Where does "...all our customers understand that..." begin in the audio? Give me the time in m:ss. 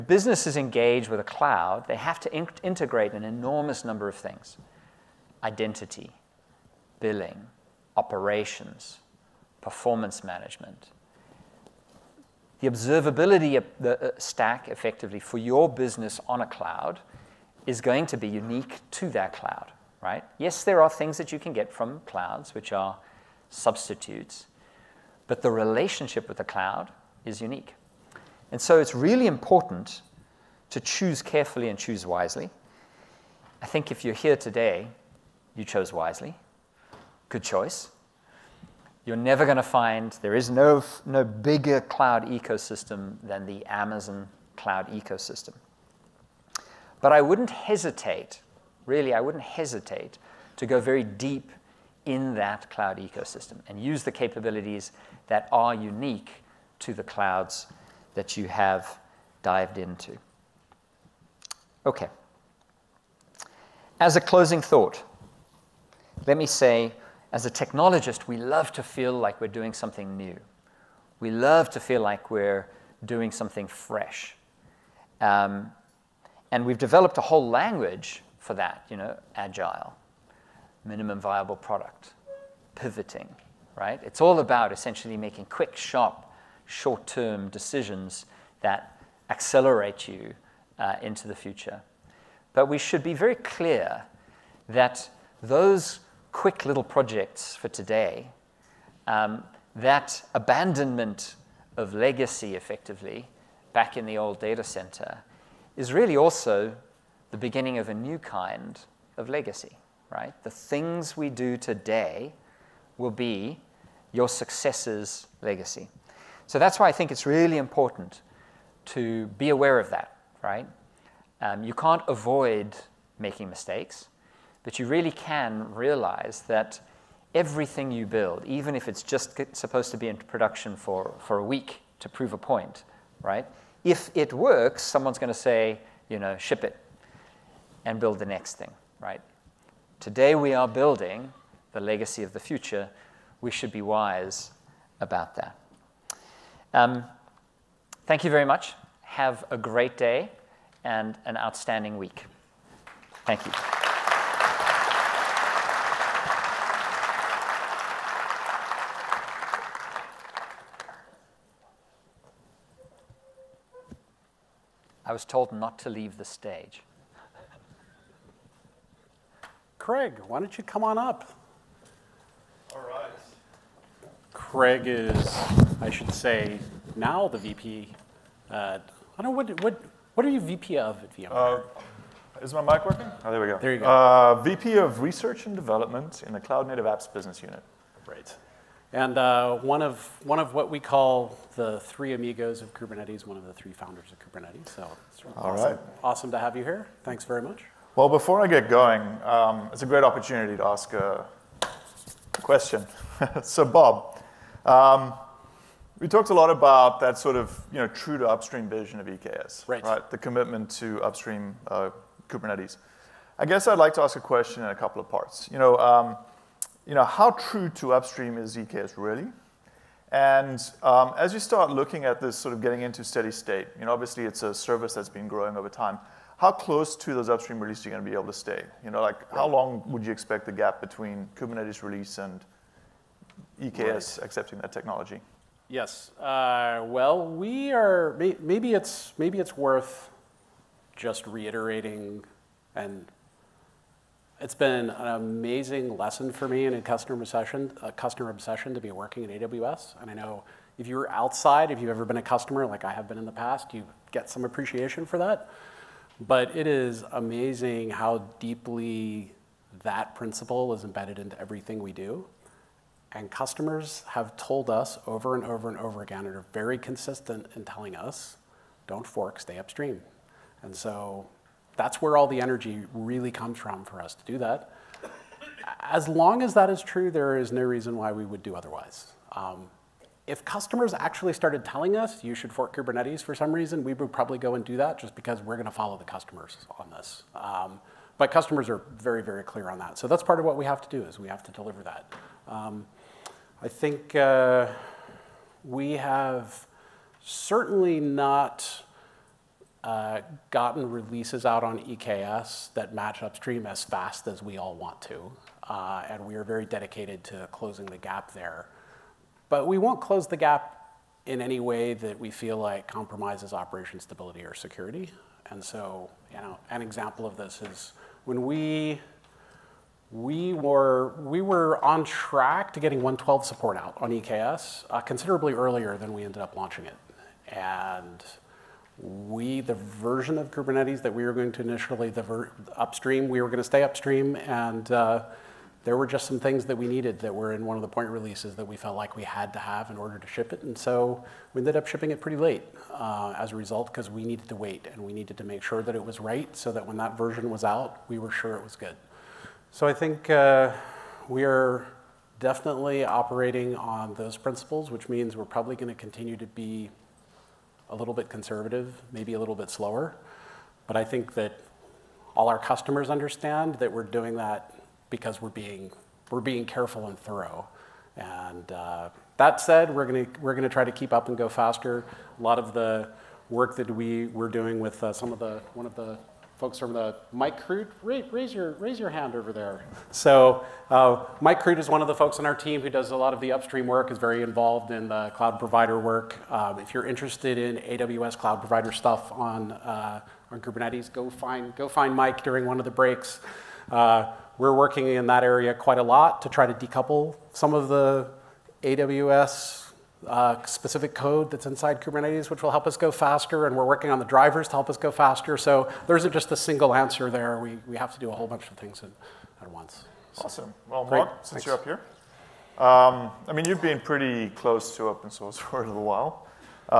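6:02.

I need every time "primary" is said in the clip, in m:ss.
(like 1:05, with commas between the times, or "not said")
not said.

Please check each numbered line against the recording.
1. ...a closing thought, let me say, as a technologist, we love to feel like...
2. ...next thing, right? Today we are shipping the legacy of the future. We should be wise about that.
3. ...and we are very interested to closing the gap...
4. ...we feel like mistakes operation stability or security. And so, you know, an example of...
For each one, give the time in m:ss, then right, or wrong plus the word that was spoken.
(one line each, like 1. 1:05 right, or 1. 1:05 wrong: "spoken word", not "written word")
1. 1:04 right
2. 2:18 wrong: "building", not "shipping"
3. 5:06 wrong: "dedicated", not "interested"
4. 5:12 wrong: "compromises", not "mistakes".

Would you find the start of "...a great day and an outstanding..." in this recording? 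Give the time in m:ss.
2:29.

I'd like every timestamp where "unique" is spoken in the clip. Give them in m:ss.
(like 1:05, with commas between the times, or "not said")
0:18, 0:27, 0:55.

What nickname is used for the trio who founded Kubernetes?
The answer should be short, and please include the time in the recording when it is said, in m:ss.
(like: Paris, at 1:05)
three amigos, at 3:11.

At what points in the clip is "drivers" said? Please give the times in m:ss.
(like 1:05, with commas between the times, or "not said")
6:44.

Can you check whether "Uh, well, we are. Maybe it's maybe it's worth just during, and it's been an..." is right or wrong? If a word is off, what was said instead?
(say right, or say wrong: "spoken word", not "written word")
wrong: "reiterating", not "during".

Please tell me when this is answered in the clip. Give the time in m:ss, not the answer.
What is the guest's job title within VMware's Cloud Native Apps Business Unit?
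3:04.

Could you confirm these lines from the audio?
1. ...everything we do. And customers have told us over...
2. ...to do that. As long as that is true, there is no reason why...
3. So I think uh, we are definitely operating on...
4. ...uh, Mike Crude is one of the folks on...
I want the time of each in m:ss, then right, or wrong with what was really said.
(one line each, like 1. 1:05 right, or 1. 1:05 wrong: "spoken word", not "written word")
1. 4:21 right
2. 4:34 right
3. 5:49 right
4. 6:20 right.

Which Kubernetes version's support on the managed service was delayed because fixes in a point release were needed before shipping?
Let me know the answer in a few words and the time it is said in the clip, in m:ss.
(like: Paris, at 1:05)
1.12, at 5:22.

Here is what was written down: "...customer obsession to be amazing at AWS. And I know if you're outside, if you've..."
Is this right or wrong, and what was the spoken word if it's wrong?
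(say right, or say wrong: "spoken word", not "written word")
wrong: "working", not "amazing".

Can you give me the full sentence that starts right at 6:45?
So there isn't just a single answer there.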